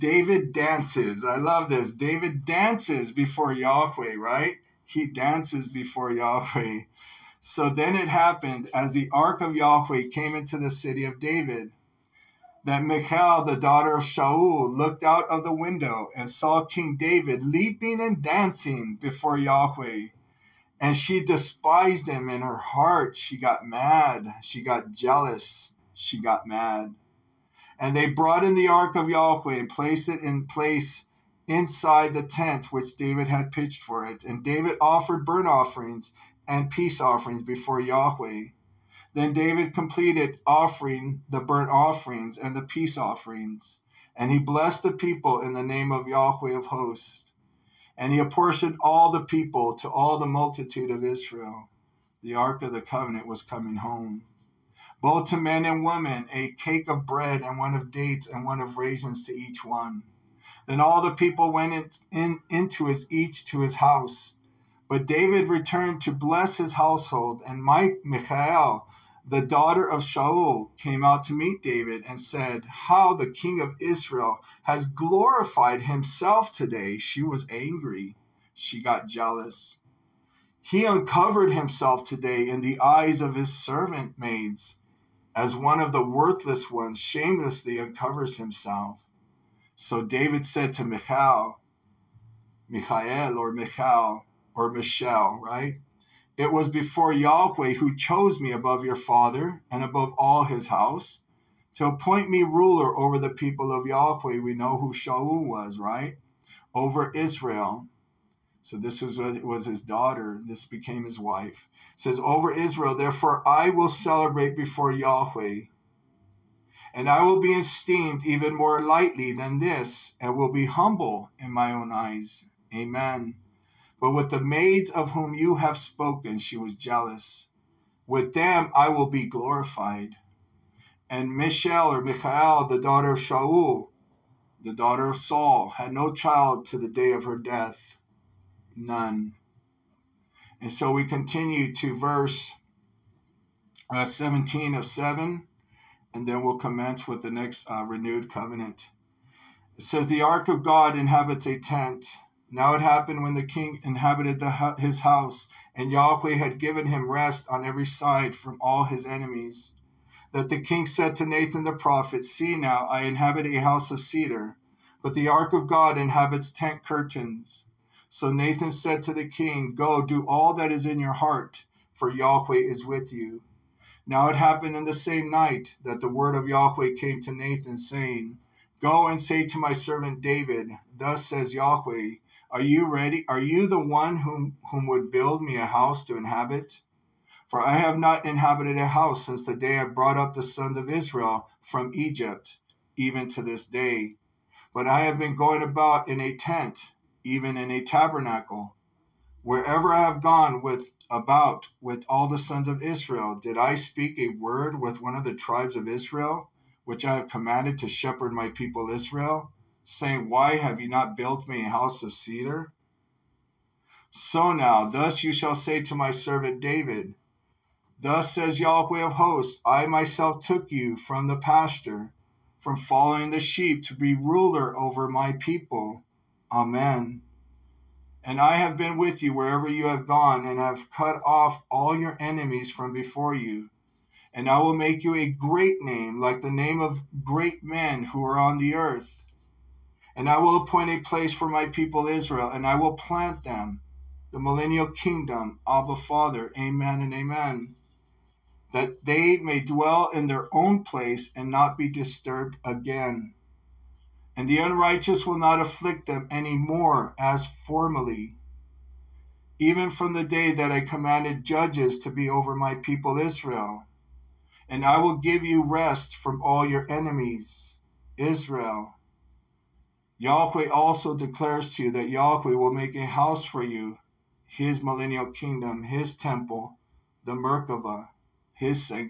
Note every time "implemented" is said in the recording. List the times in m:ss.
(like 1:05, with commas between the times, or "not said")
not said.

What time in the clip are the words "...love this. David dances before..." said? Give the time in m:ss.
0:01.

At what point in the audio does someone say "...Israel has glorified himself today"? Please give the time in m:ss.
1:13.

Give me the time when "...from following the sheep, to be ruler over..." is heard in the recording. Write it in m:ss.
3:42.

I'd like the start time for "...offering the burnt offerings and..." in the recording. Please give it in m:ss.
0:40.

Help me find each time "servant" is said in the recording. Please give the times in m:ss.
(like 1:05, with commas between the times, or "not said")
1:23, 2:59, 3:36.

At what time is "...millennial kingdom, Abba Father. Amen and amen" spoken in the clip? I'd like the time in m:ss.
4:04.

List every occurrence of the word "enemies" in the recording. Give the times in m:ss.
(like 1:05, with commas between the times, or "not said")
2:39, 3:52, 4:26.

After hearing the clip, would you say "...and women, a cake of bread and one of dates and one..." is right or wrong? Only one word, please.
right.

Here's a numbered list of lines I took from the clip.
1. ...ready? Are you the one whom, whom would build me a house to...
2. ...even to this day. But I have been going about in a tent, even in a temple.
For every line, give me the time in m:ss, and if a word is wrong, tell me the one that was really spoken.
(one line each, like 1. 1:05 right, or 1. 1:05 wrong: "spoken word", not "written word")
1. 3:02 right
2. 3:12 wrong: "tabernacle", not "temple".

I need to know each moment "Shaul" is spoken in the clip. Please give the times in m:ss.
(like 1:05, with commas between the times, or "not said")
0:14, 1:10, 1:44, 2:13.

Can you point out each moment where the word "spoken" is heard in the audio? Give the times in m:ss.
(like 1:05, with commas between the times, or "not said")
2:05.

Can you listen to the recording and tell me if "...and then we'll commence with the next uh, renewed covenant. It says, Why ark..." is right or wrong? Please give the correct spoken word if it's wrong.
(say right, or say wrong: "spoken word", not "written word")
wrong: "The", not "Why".